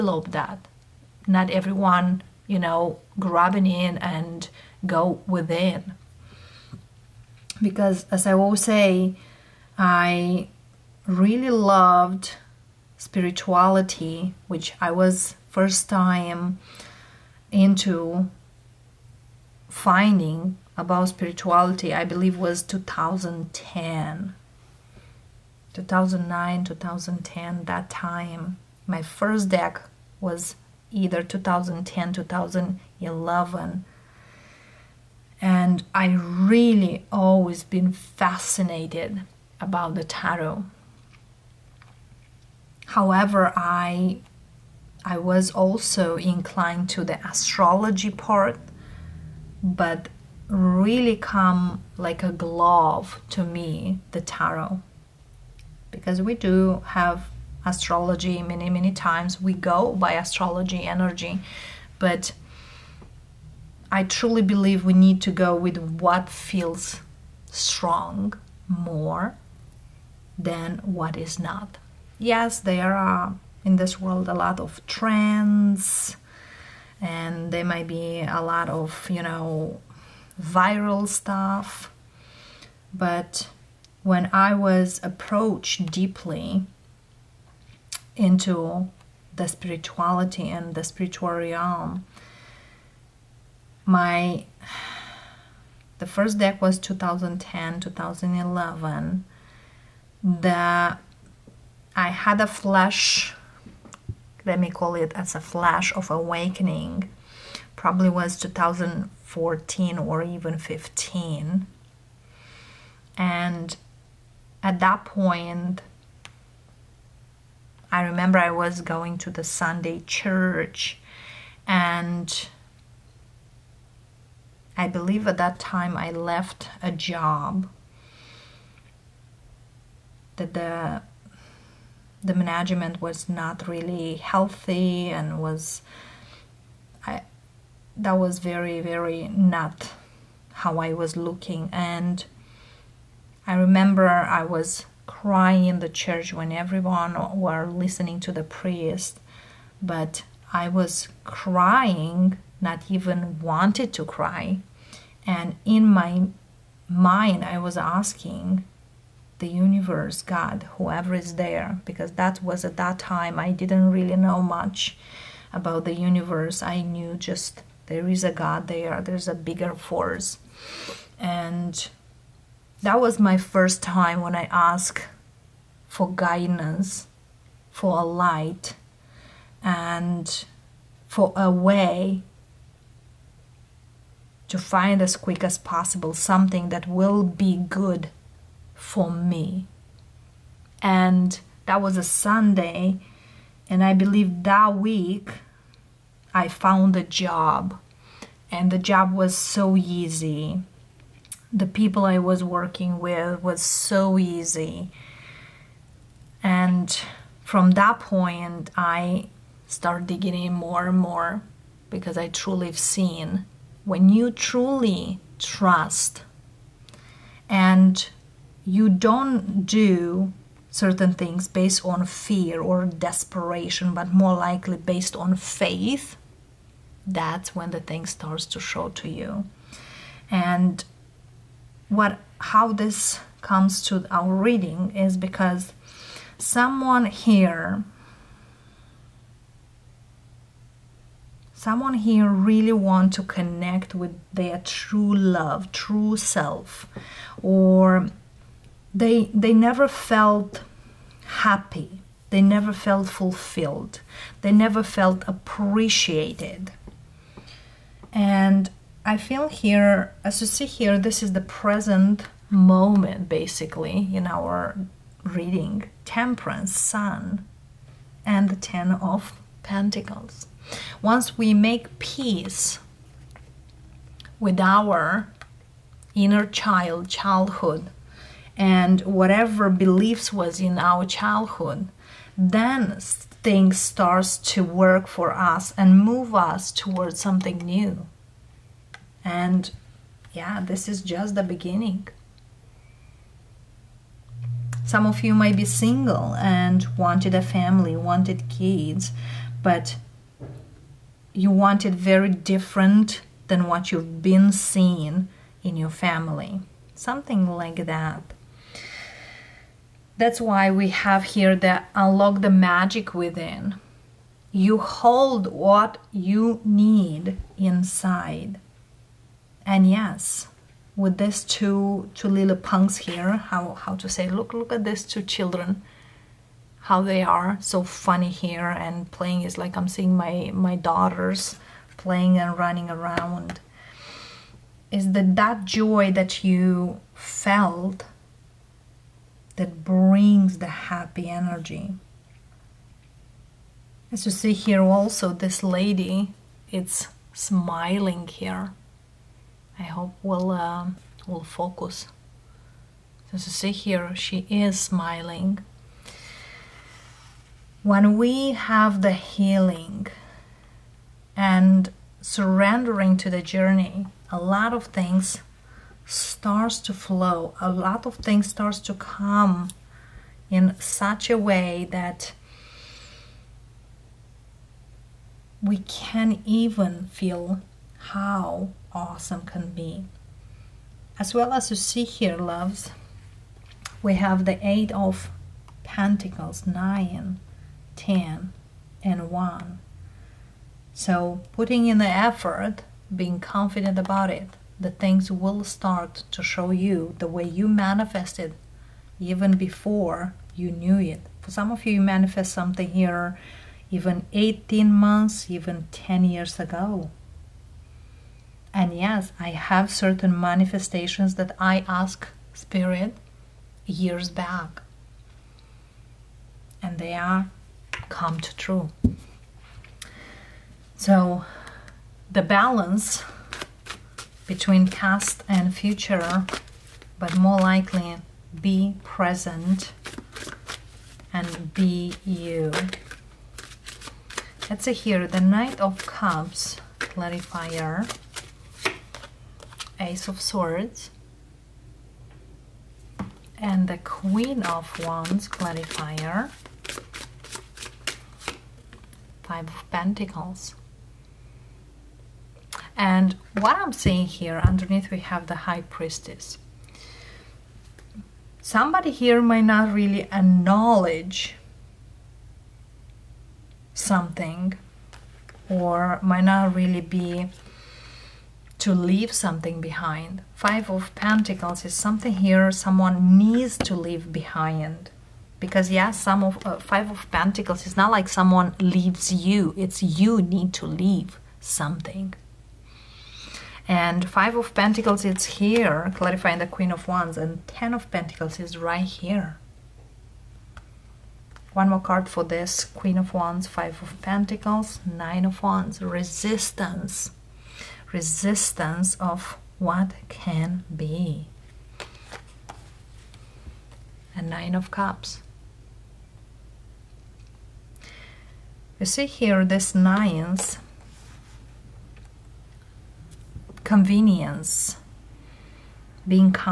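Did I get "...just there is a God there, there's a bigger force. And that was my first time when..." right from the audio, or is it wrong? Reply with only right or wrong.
right.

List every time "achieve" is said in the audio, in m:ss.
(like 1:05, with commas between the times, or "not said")
not said.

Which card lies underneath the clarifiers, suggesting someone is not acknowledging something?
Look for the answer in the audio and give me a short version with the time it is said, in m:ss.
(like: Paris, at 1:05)
High Priestess, at 7:35.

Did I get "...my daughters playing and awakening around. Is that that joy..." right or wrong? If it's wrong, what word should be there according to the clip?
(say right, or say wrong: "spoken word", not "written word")
wrong: "running", not "awakening".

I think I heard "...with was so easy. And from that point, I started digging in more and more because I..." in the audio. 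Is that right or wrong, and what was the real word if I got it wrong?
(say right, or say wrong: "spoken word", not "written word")
right.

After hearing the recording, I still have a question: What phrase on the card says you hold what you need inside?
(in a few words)
unlock the magic within.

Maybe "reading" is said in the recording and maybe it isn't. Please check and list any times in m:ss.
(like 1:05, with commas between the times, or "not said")
3:54, 4:25.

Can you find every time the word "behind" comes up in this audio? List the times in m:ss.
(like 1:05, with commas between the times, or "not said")
7:49, 7:54.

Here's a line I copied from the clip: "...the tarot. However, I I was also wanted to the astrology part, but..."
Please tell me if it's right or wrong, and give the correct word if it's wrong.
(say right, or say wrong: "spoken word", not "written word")
wrong: "inclined", not "wanted".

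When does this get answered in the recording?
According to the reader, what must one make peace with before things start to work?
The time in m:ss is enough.
4:36.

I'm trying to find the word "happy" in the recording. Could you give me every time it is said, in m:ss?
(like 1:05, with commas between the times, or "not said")
4:11, 5:40.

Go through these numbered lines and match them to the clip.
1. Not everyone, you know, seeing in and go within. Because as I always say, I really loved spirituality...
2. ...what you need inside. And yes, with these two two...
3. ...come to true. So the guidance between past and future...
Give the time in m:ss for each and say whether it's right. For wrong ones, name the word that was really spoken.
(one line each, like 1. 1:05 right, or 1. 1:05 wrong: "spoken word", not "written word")
1. 0:01 wrong: "grabbing", not "seeing"
2. 5:15 right
3. 6:58 wrong: "balance", not "guidance".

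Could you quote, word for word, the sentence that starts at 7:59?
It's you need to leave something.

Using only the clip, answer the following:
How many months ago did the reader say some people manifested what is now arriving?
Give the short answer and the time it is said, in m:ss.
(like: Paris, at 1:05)
18, at 6:44.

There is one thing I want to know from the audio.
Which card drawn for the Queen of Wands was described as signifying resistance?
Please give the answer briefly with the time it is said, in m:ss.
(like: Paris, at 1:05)
Nine of Wands, at 8:15.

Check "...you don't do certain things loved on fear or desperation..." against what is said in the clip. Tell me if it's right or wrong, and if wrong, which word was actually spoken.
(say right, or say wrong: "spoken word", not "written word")
wrong: "based", not "loved".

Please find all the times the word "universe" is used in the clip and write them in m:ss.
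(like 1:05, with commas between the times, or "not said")
2:39, 2:45.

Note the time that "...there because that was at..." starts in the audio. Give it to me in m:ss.
2:41.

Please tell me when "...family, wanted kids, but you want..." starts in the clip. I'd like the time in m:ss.
4:57.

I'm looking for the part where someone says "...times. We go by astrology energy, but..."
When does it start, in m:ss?
0:58.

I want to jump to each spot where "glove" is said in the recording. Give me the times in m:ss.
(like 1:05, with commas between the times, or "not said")
0:52.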